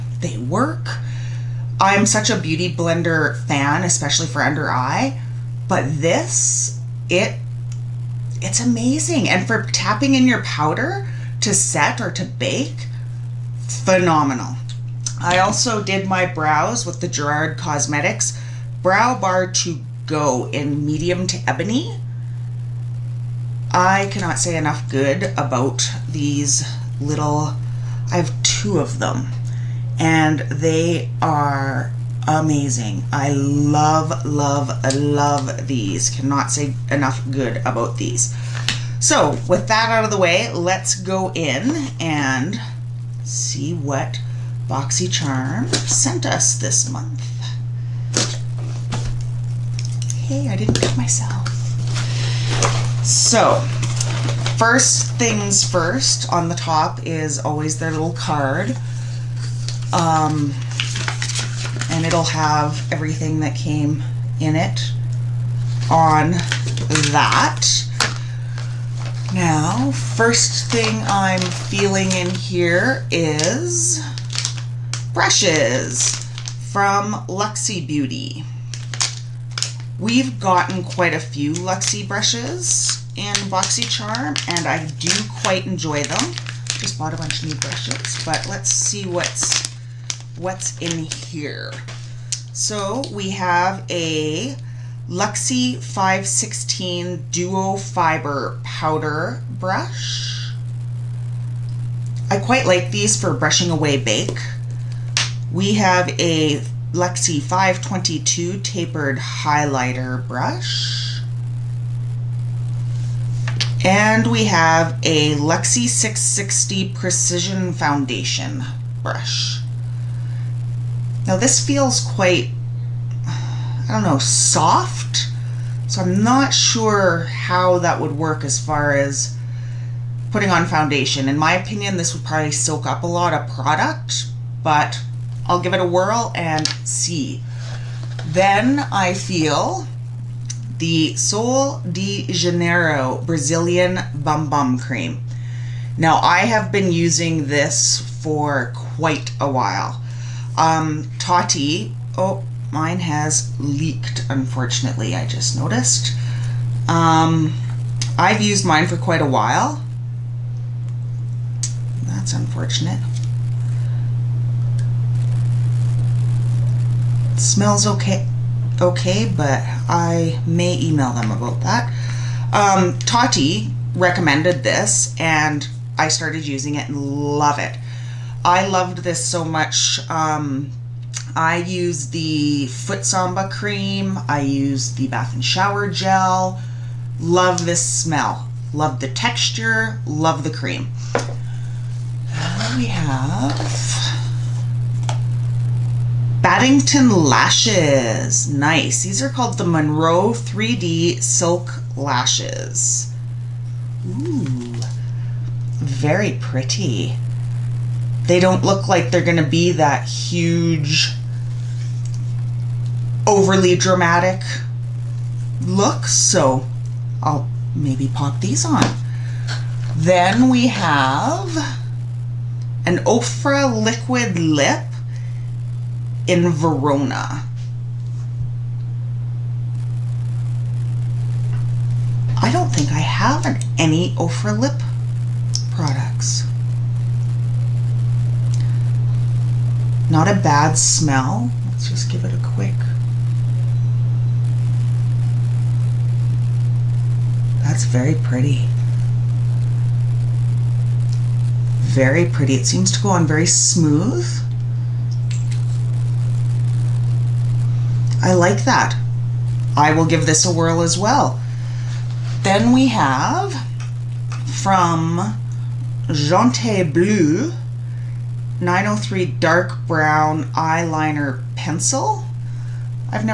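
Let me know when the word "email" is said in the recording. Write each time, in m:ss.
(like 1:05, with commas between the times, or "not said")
2:50.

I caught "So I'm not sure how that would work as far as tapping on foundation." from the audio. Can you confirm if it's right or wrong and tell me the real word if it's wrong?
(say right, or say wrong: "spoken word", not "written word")
wrong: "putting", not "tapping".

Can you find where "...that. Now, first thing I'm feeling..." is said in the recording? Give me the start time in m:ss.
1:07.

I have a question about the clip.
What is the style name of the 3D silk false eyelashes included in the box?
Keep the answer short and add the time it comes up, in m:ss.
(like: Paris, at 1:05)
Monroe, at 3:19.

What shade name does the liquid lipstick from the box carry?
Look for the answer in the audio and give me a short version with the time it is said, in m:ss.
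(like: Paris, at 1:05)
Verona, at 3:46.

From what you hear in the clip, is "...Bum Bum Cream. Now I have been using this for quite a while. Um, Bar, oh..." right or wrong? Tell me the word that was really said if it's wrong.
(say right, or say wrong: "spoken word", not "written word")
wrong: "Tati", not "Bar".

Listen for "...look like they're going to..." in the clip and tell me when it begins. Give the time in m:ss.
3:28.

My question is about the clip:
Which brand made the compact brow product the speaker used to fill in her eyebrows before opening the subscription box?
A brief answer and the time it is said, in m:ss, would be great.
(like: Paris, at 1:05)
Gerard Cosmetics, at 0:17.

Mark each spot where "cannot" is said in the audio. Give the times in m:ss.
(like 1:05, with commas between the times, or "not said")
0:24, 0:36.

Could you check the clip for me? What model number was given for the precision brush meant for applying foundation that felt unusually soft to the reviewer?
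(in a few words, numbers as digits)
660.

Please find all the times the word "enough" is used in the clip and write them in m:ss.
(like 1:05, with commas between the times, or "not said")
0:24, 0:36.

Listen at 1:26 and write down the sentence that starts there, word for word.
Just bought a bunch of new brushes, but let's see what's what's in here.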